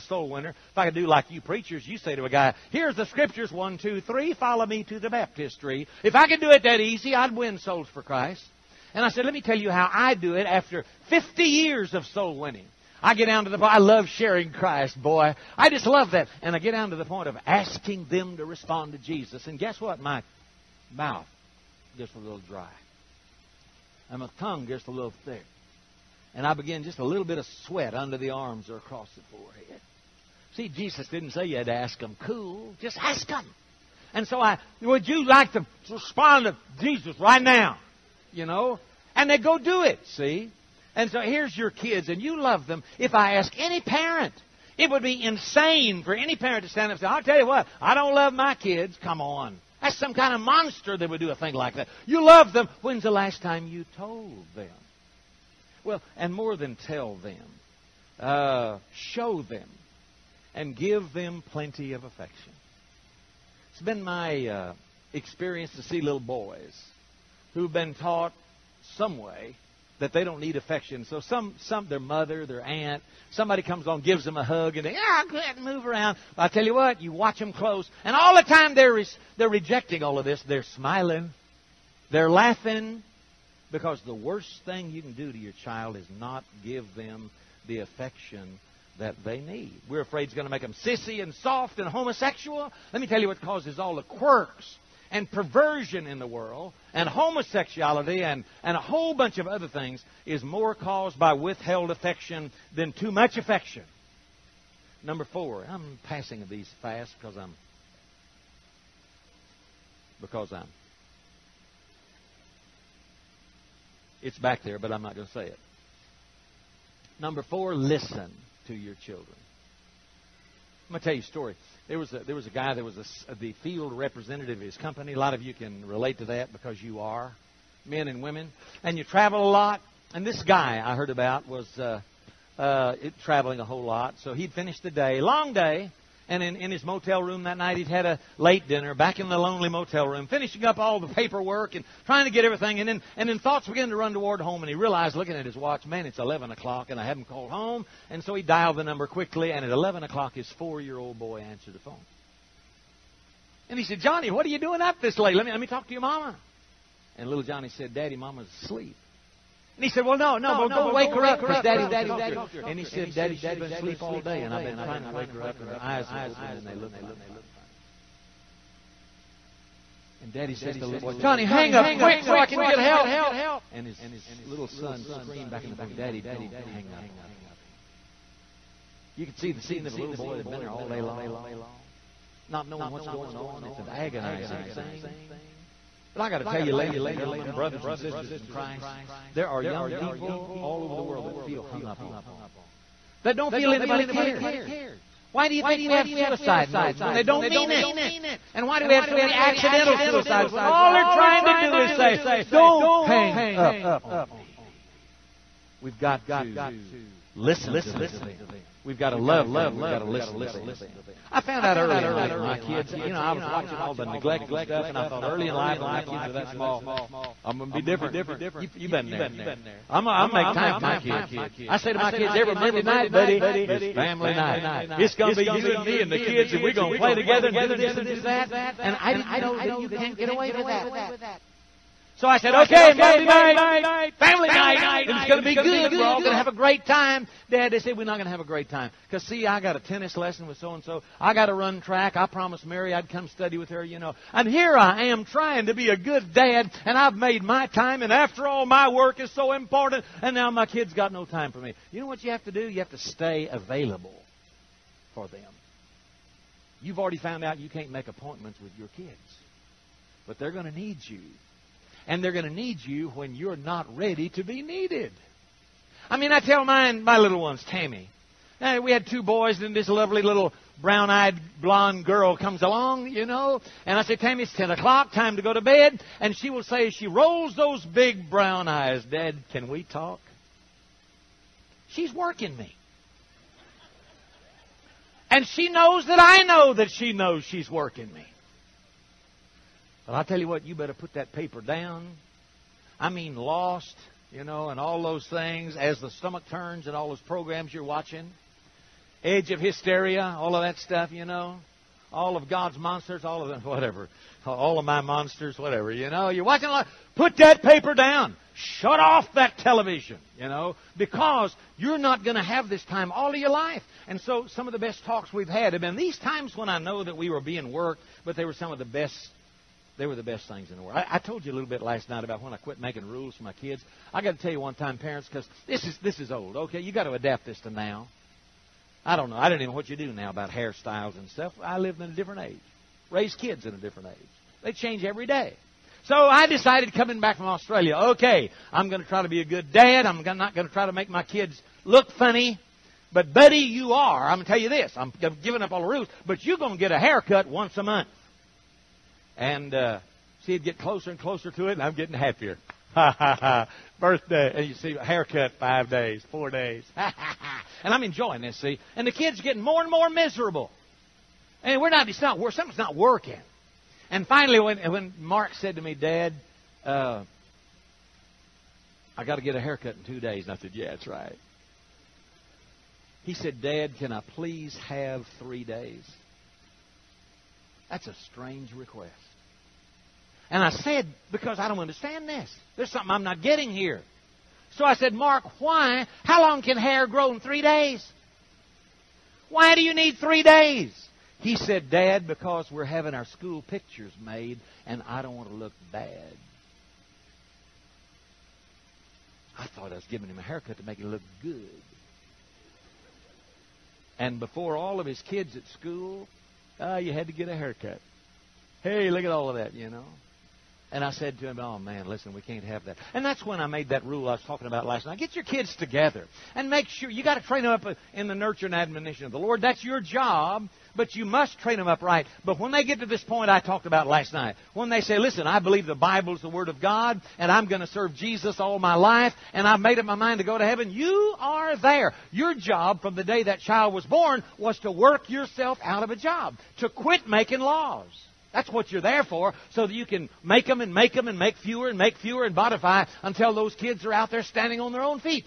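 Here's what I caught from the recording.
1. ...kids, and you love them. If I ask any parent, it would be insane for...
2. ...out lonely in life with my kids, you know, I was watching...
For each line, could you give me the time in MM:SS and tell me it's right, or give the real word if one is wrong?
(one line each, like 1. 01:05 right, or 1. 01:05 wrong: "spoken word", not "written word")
1. 00:41 right
2. 03:31 wrong: "early", not "lonely".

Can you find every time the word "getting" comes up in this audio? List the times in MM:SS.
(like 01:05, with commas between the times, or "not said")
05:51, 05:59, 06:23.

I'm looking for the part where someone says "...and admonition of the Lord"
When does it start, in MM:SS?
06:58.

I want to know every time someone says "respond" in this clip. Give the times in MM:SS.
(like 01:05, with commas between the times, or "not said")
00:18, 00:35.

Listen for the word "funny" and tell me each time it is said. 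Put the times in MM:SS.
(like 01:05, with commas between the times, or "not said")
02:47, 05:42.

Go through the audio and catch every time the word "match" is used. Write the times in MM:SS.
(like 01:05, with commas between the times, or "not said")
not said.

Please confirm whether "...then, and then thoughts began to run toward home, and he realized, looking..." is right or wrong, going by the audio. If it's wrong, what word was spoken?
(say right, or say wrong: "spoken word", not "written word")
right.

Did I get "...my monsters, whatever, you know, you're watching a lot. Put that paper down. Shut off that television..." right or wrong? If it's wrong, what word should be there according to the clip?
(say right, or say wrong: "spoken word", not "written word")
right.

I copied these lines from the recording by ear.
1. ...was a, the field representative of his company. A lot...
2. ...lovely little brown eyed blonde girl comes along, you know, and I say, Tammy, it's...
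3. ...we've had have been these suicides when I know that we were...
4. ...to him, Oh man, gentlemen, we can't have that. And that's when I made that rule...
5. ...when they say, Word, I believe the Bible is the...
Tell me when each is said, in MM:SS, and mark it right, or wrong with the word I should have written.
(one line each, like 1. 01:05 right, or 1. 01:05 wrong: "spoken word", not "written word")
1. 02:02 right
2. 04:29 right
3. 05:15 wrong: "times", not "suicides"
4. 06:51 wrong: "listen", not "gentlemen"
5. 07:04 wrong: "Listen", not "Word".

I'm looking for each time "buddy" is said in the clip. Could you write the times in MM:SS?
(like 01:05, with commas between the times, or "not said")
03:43, 05:43.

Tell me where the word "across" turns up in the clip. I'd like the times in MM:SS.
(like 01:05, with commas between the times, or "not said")
00:28.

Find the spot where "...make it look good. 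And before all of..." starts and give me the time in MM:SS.
06:40.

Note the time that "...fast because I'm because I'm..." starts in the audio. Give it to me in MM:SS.
01:46.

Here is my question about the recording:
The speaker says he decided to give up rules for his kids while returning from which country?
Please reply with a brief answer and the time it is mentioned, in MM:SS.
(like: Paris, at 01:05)
Australia, at 05:37.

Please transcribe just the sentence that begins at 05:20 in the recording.
I, I told you a little bit last night about when I quit making rules for my kids.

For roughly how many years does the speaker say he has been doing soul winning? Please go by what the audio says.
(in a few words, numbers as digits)
50 years.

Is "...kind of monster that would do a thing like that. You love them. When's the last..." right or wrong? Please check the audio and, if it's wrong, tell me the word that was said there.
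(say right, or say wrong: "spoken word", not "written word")
right.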